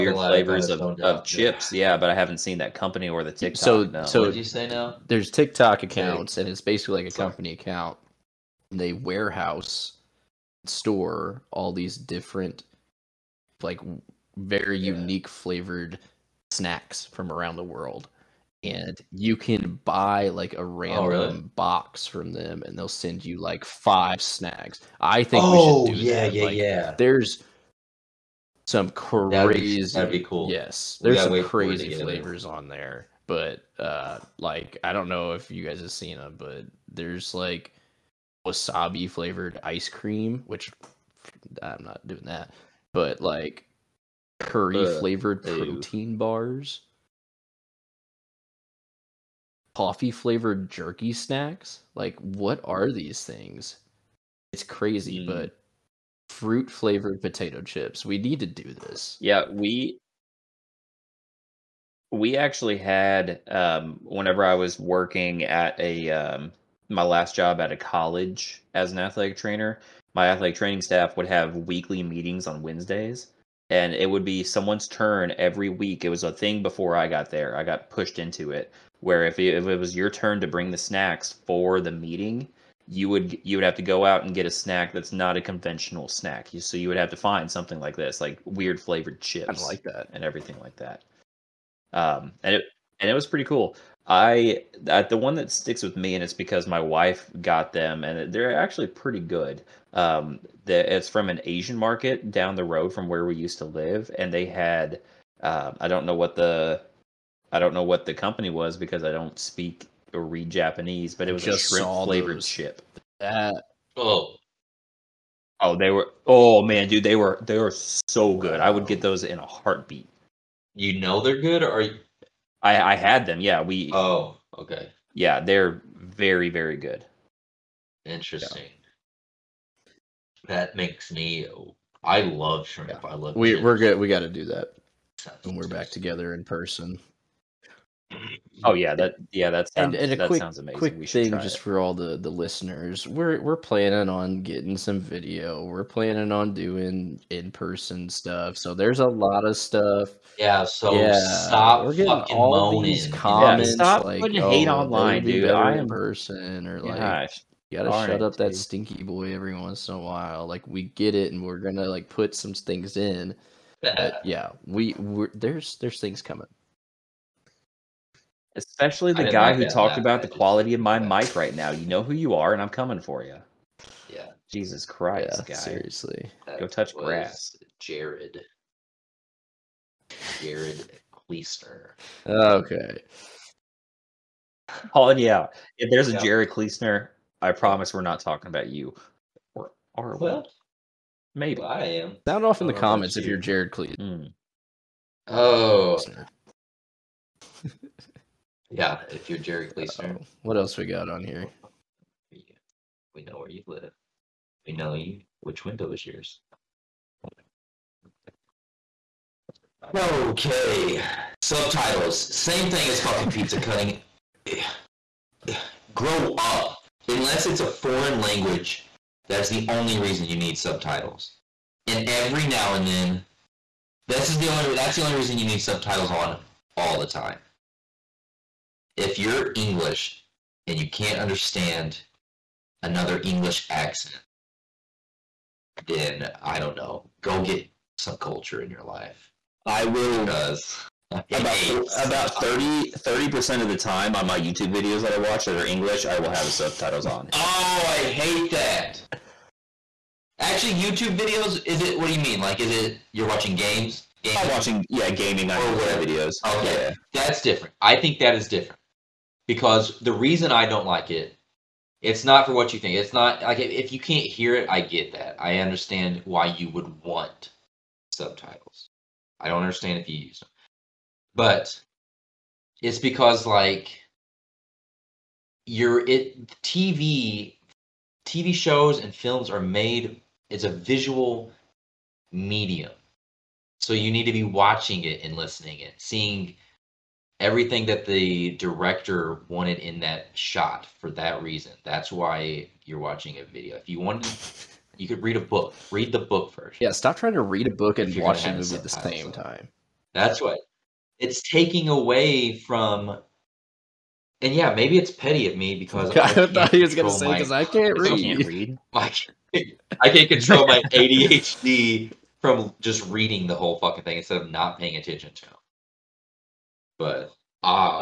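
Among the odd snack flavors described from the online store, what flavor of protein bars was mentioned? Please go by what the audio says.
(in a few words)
Curry.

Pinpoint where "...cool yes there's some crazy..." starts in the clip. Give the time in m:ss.
0:30.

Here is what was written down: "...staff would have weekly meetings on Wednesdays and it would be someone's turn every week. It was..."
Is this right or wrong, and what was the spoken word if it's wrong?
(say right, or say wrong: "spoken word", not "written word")
right.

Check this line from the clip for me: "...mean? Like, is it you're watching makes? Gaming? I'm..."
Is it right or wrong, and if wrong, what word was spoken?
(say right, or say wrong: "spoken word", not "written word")
wrong: "games", not "makes".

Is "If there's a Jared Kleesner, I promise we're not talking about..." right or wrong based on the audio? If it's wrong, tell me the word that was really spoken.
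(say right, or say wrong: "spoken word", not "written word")
right.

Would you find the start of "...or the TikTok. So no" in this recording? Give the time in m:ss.
0:03.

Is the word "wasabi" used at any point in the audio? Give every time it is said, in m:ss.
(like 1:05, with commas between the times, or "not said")
0:38.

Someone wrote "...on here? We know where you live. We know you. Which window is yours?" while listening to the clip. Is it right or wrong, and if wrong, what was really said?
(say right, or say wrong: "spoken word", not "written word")
right.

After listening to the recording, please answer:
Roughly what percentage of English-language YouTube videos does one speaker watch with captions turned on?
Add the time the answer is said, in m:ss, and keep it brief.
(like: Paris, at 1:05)
30 percent, at 4:02.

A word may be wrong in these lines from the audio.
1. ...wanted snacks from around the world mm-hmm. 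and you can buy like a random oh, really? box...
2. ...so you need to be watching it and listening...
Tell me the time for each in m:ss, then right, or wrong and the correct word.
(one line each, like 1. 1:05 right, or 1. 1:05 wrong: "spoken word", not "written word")
1. 0:15 wrong: "flavored", not "wanted"
2. 4:43 right.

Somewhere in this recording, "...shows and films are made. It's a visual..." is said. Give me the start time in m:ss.
4:38.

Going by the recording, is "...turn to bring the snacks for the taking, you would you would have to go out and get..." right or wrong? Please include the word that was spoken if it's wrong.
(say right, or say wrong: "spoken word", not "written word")
wrong: "meeting", not "taking".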